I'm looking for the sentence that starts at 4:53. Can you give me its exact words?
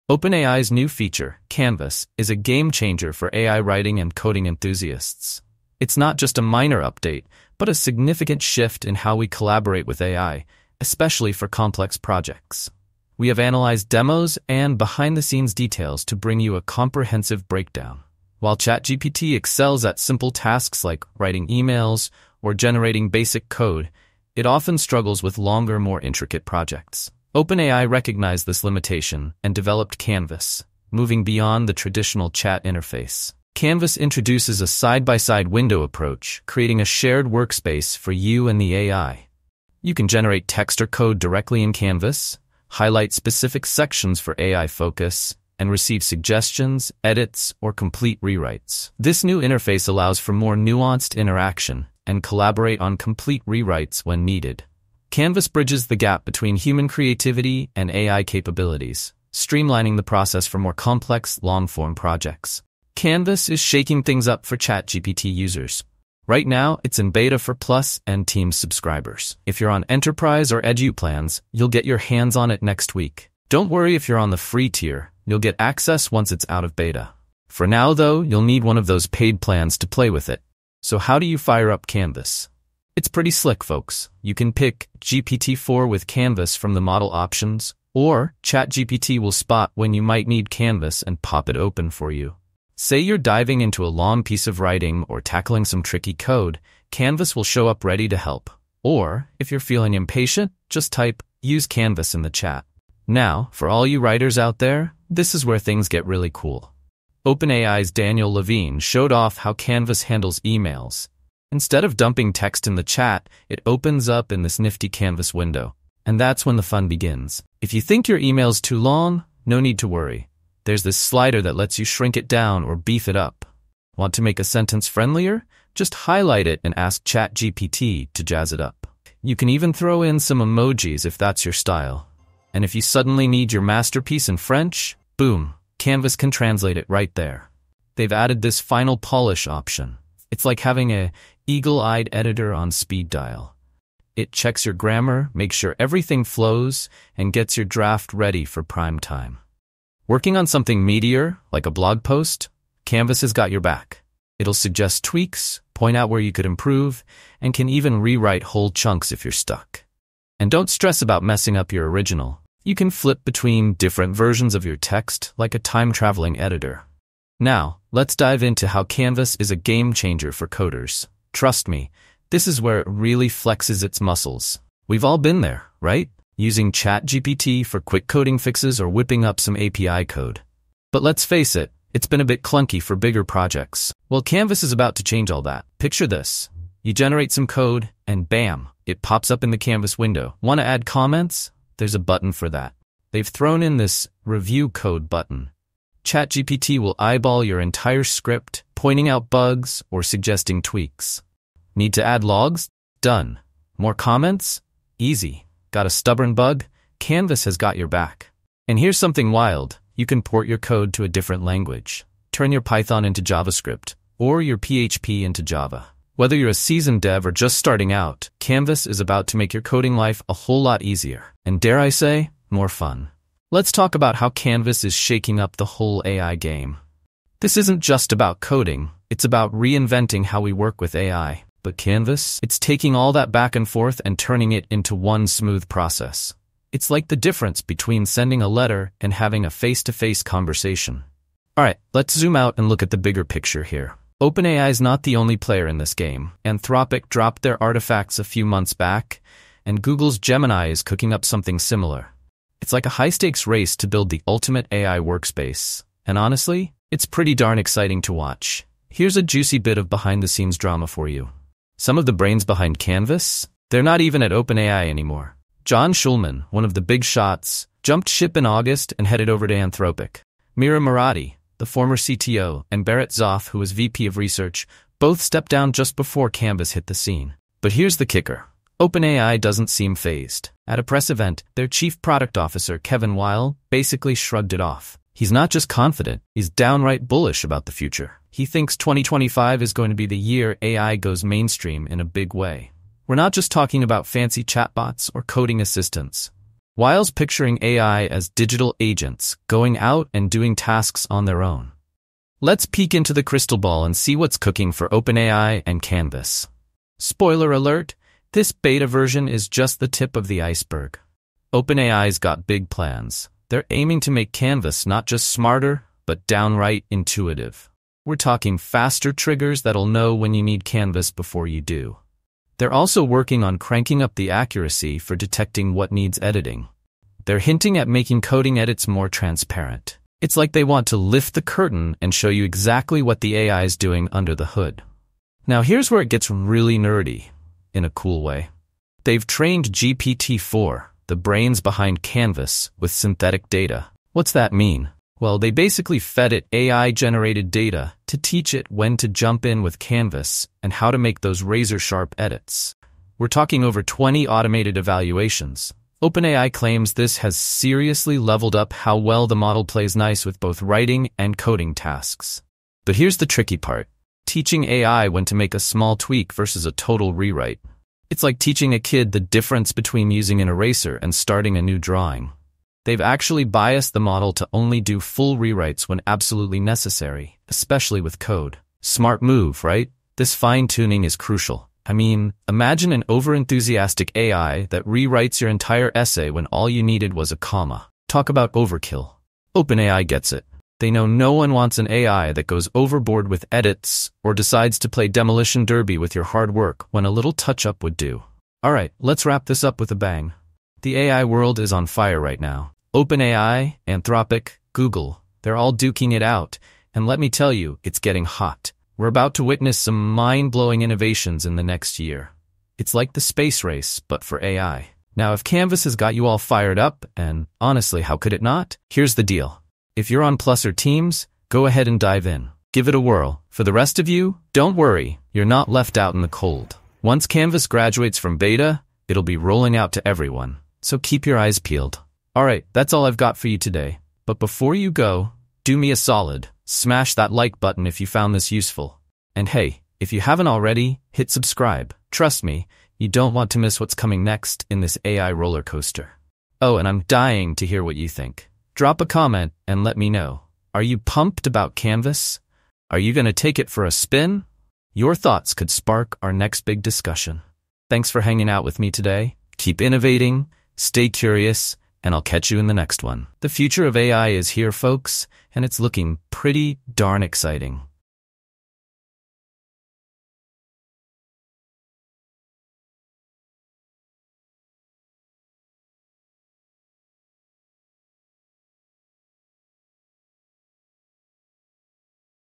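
We're not just talking about fancy chatbots or coding assistants.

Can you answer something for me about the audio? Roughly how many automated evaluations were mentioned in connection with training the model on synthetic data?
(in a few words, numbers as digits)
over 20.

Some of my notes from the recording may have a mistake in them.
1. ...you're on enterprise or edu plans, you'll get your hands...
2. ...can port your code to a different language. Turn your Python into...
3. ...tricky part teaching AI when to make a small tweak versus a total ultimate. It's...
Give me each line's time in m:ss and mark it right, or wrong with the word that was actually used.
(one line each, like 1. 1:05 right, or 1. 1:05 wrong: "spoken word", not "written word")
1. 1:09 right
2. 3:30 right
3. 6:03 wrong: "rewrite", not "ultimate".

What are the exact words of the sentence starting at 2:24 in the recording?
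It checks your grammar, makes sure everything flows, and gets your draft ready for prime time.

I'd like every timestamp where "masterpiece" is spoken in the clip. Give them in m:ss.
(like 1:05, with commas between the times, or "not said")
2:13.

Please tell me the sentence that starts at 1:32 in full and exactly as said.
Say you're diving into a long piece of writing or tackling some tricky code, Canvas will show up ready to help.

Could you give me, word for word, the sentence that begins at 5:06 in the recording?
Spoiler alert, this beta version is just the tip of the iceberg.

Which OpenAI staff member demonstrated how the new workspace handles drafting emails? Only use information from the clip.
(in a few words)
Daniel Levine.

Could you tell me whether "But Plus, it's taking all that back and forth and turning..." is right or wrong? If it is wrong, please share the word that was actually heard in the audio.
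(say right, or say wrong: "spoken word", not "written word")
wrong: "Canvas", not "Plus".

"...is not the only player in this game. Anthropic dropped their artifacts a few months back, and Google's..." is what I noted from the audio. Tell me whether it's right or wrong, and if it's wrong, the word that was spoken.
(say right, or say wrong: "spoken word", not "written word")
right.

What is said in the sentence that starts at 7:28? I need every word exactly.
Drop a comment and let me know.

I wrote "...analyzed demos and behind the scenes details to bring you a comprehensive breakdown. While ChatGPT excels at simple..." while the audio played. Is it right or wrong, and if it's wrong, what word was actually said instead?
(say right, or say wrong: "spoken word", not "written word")
right.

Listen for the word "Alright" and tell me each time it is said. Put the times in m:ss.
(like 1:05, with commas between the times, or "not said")
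4:01, 7:12.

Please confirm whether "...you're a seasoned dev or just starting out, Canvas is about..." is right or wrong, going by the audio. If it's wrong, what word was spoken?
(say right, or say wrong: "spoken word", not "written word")
right.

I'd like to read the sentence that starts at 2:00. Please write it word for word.
There's this slider that lets you shrink it down or beef it up.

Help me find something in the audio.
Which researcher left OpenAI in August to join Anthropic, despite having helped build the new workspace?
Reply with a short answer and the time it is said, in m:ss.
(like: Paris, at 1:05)
John Schulman, at 4:25.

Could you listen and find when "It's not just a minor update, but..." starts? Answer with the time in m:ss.
0:05.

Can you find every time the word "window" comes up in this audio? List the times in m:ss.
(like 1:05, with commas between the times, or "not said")
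0:35, 1:55, 3:09.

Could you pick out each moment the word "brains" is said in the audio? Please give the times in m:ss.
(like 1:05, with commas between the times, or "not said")
4:22, 5:41.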